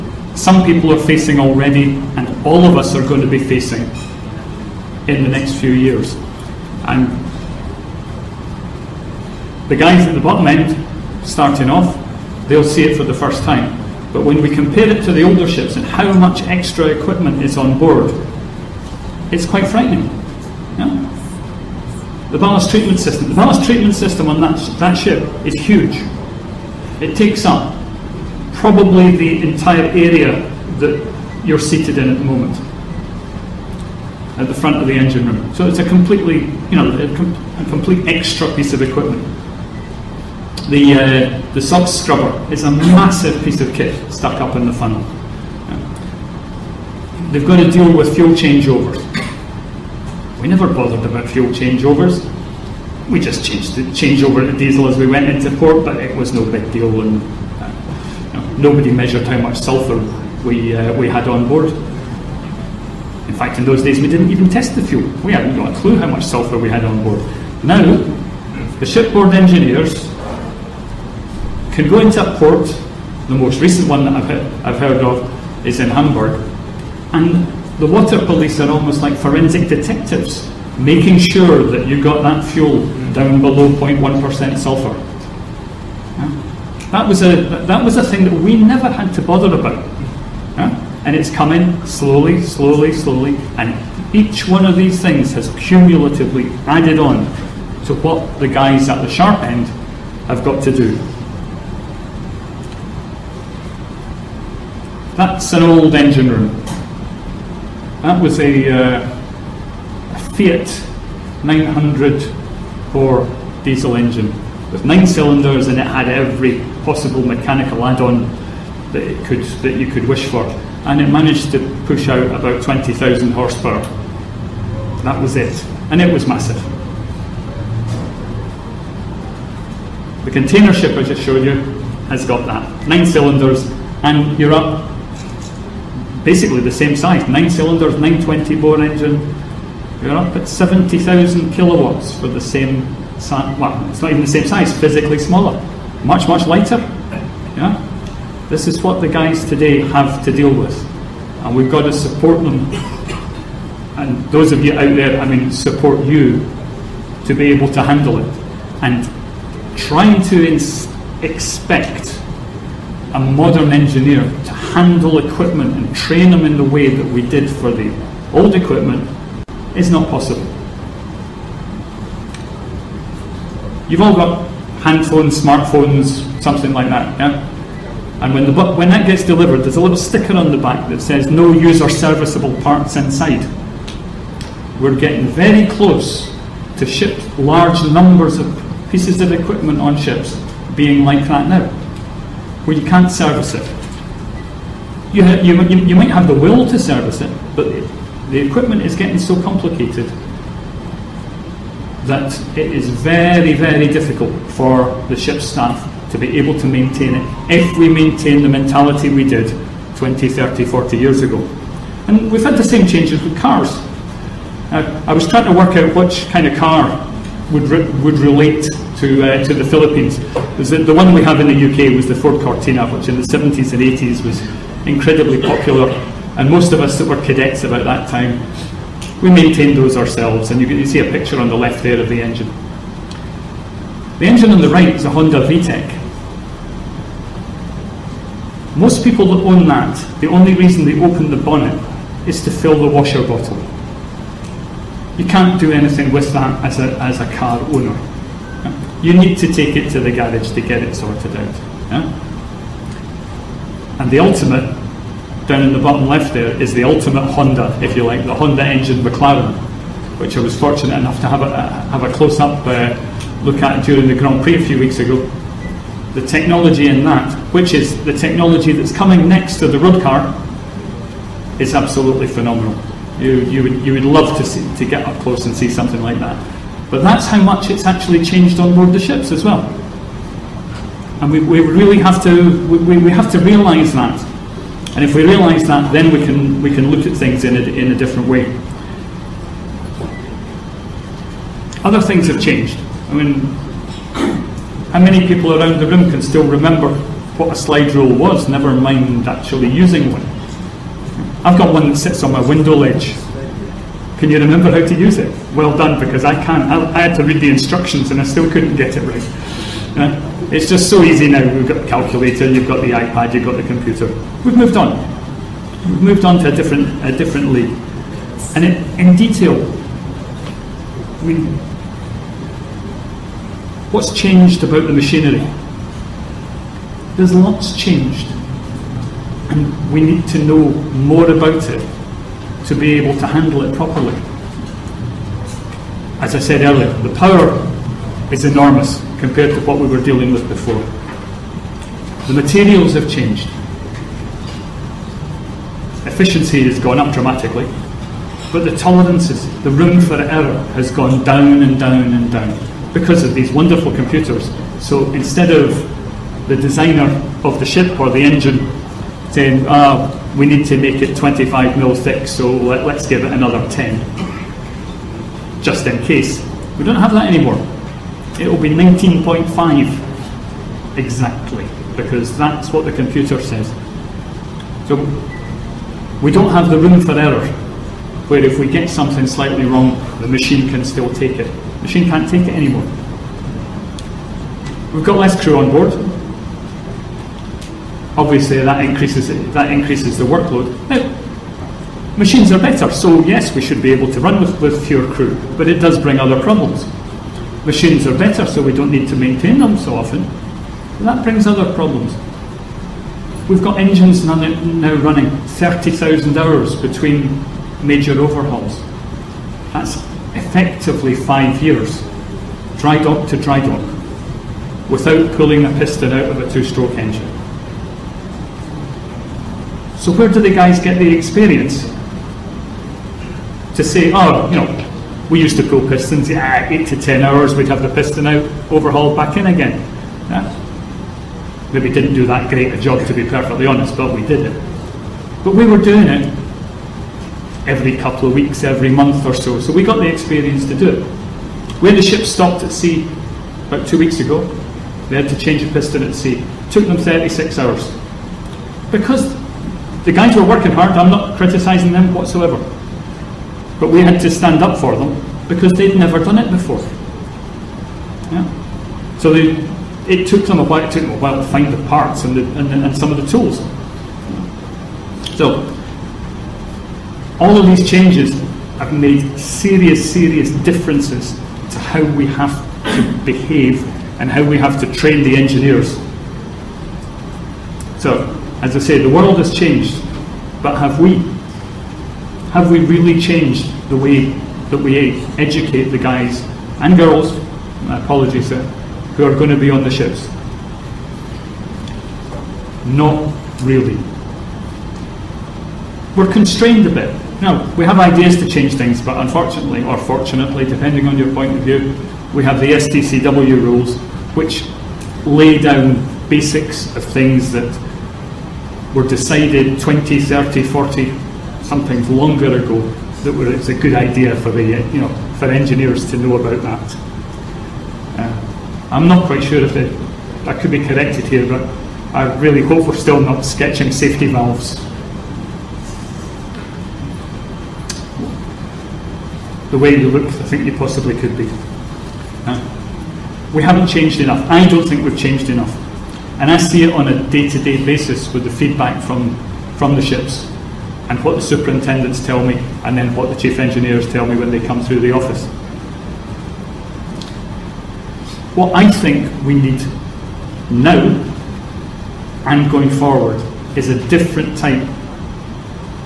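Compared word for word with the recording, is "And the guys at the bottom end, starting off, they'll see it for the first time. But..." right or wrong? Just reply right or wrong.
right.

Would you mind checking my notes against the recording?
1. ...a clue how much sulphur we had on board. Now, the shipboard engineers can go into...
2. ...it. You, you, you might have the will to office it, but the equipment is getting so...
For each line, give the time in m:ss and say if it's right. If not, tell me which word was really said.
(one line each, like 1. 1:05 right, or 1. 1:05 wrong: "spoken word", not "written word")
1. 1:05 right
2. 3:13 wrong: "service", not "office".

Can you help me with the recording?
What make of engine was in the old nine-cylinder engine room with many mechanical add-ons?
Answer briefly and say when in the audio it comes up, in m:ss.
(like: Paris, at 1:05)
Fiat, at 1:50.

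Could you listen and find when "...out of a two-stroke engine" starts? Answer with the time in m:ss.
6:56.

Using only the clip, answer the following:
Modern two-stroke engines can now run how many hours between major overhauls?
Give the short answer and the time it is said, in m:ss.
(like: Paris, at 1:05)
30,000, at 6:45.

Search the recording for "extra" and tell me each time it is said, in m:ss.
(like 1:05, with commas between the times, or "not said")
0:16, 0:38.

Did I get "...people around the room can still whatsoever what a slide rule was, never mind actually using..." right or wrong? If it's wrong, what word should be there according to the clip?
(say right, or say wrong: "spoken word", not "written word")
wrong: "remember", not "whatsoever".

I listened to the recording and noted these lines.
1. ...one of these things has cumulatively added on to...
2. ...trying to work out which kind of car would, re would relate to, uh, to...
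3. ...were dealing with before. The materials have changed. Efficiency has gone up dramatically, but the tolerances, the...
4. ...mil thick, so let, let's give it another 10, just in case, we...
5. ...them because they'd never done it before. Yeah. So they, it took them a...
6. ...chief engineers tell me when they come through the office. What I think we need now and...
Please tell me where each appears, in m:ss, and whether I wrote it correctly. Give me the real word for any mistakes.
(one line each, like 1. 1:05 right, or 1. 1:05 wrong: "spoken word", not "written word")
1. 1:34 right
2. 3:35 right
3. 5:39 right
4. 6:01 right
5. 7:34 right
6. 9:03 right.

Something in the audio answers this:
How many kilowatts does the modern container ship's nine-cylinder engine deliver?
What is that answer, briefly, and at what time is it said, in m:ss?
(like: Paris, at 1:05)
70,000, at 2:20.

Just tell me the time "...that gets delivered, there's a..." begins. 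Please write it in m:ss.
2:58.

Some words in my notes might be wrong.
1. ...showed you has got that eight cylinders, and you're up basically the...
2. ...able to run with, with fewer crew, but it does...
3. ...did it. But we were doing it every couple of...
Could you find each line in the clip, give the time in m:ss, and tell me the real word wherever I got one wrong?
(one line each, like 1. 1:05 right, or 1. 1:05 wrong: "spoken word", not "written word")
1. 2:11 wrong: "nine", not "eight"
2. 6:33 right
3. 7:14 right.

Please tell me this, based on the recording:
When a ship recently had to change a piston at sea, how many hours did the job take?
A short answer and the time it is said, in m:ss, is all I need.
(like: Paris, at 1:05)
36, at 7:26.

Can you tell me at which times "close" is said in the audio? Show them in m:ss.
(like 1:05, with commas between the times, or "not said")
3:05, 4:22, 4:35.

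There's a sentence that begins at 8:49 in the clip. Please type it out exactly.
The way you look, I think you possibly could be.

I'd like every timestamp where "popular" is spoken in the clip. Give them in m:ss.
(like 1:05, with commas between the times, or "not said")
3:45.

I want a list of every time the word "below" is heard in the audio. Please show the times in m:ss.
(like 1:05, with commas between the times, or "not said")
1:23.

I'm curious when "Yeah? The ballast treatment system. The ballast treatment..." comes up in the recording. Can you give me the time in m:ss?
0:20.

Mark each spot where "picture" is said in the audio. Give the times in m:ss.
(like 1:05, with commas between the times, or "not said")
3:51.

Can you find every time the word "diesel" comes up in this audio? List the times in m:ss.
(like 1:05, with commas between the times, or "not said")
0:54, 1:53.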